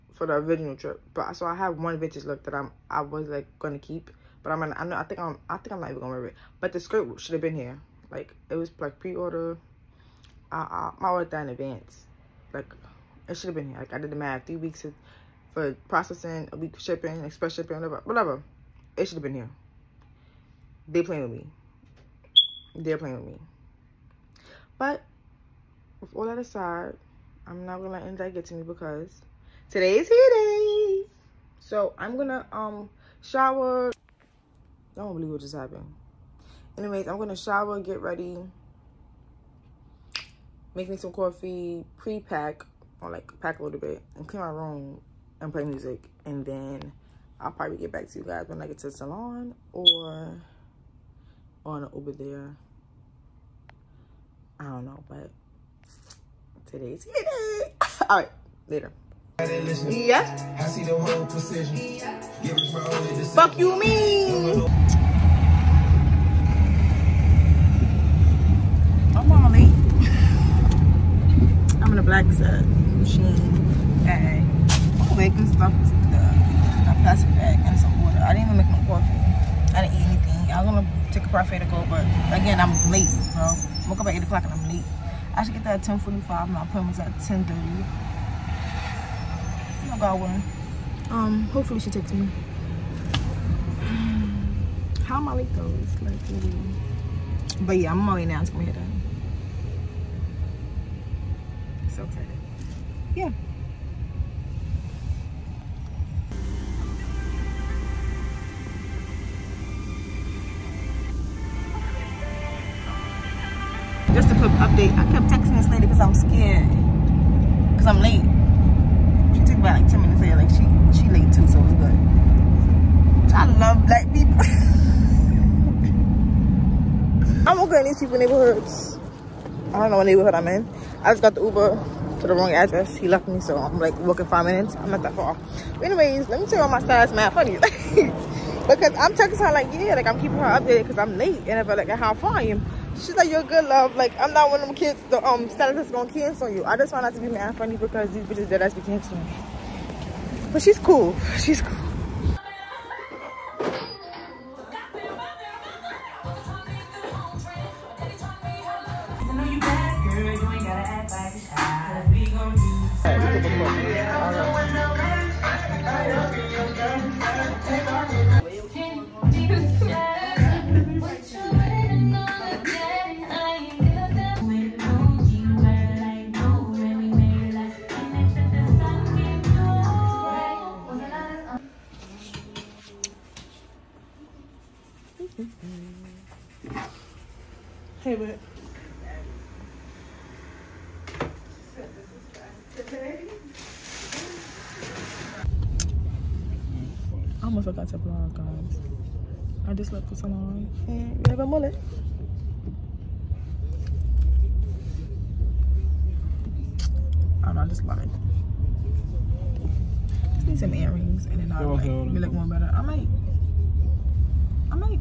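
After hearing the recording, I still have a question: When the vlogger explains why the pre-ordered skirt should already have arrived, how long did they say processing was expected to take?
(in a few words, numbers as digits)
3 weeks.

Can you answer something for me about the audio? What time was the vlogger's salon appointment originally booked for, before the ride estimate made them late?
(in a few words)
10:30.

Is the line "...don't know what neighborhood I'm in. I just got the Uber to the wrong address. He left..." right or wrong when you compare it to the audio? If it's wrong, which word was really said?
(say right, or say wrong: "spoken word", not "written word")
right.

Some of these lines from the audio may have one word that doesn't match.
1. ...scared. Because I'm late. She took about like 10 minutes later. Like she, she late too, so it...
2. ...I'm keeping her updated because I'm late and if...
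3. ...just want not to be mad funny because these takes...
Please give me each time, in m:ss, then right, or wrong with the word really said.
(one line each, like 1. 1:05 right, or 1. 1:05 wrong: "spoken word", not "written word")
1. 1:56 right
2. 2:20 right
3. 2:26 wrong: "bitches", not "takes".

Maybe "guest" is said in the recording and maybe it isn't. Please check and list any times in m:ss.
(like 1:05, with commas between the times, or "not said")
not said.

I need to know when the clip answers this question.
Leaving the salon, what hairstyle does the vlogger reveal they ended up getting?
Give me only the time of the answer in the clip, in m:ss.
3:21.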